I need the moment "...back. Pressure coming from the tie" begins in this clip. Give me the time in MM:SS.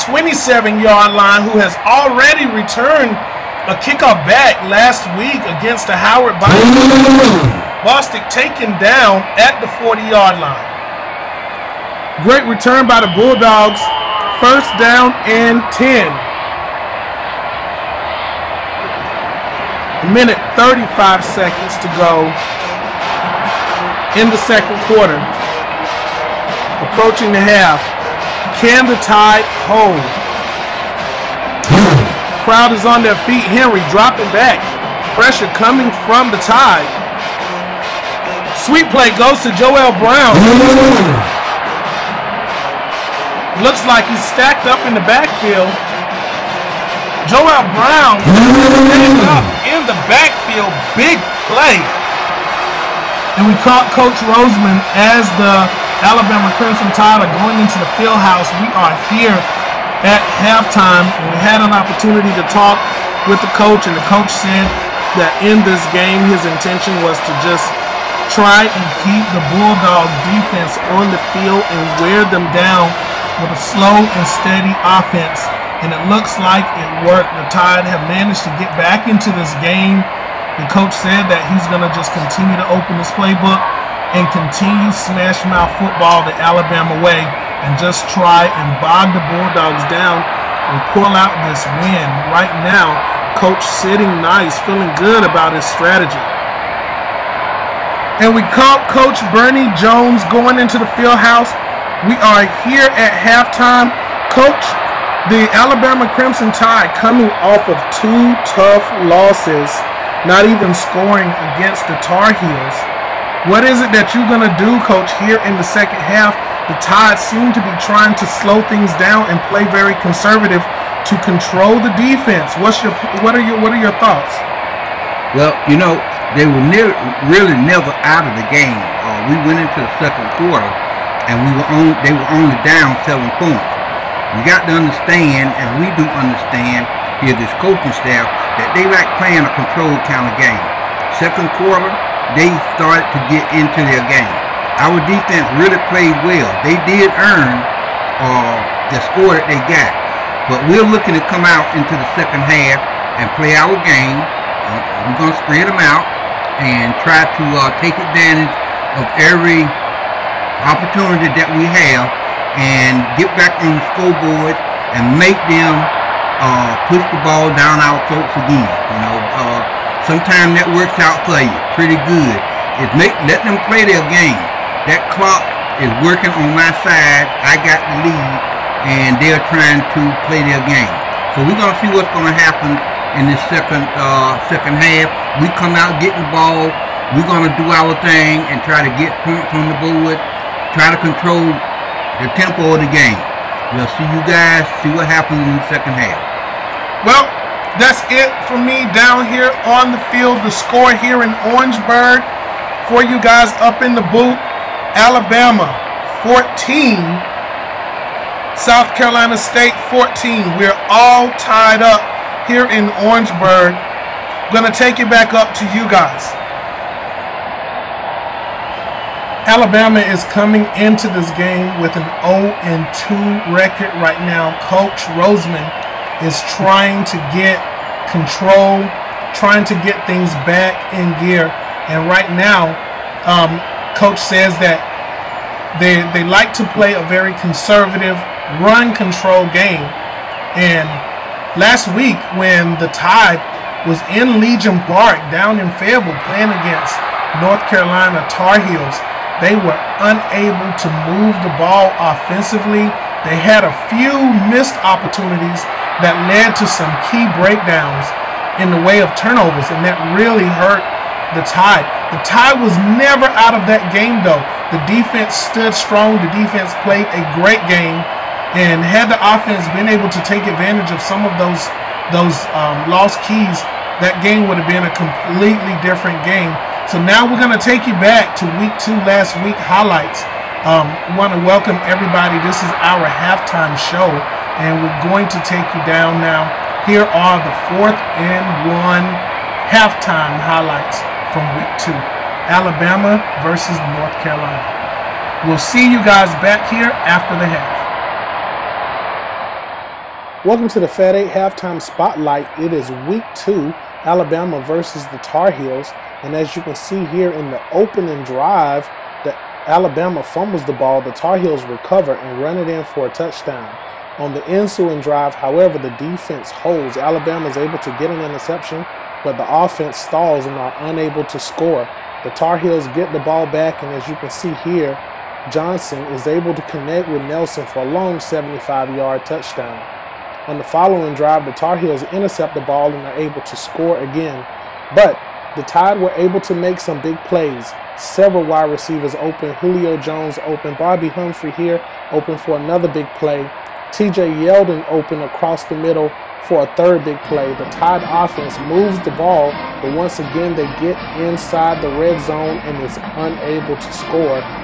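00:34.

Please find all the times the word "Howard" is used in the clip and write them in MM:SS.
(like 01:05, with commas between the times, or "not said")
00:05.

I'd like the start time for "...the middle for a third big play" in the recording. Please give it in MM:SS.
05:45.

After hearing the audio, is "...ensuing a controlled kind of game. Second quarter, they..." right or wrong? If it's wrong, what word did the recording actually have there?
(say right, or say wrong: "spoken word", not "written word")
wrong: "playing", not "ensuing".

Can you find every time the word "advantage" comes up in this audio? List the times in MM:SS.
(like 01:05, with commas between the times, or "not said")
02:38, 04:30.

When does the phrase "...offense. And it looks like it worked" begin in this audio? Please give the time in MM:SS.
01:14.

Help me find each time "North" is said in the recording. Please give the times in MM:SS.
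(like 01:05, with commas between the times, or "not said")
04:07, 04:53.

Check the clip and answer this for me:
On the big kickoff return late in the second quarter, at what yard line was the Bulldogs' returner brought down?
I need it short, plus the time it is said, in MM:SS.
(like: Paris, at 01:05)
40-yard line, at 00:09.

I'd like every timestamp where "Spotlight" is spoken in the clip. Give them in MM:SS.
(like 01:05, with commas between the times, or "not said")
05:01.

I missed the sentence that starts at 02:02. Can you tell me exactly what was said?
What's your what are your what are your thoughts?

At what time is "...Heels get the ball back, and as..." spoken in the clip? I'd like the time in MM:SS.
05:22.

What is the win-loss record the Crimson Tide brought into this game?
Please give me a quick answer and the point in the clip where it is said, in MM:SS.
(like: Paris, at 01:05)
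0-2, at 03:42.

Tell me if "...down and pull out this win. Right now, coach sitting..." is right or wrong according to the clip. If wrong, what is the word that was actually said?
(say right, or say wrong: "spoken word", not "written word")
right.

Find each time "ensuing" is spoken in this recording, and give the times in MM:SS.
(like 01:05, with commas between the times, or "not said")
05:14.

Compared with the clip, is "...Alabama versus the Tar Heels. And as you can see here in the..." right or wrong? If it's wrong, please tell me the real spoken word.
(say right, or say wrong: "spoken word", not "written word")
right.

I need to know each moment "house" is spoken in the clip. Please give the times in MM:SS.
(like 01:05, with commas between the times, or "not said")
00:58, 01:41.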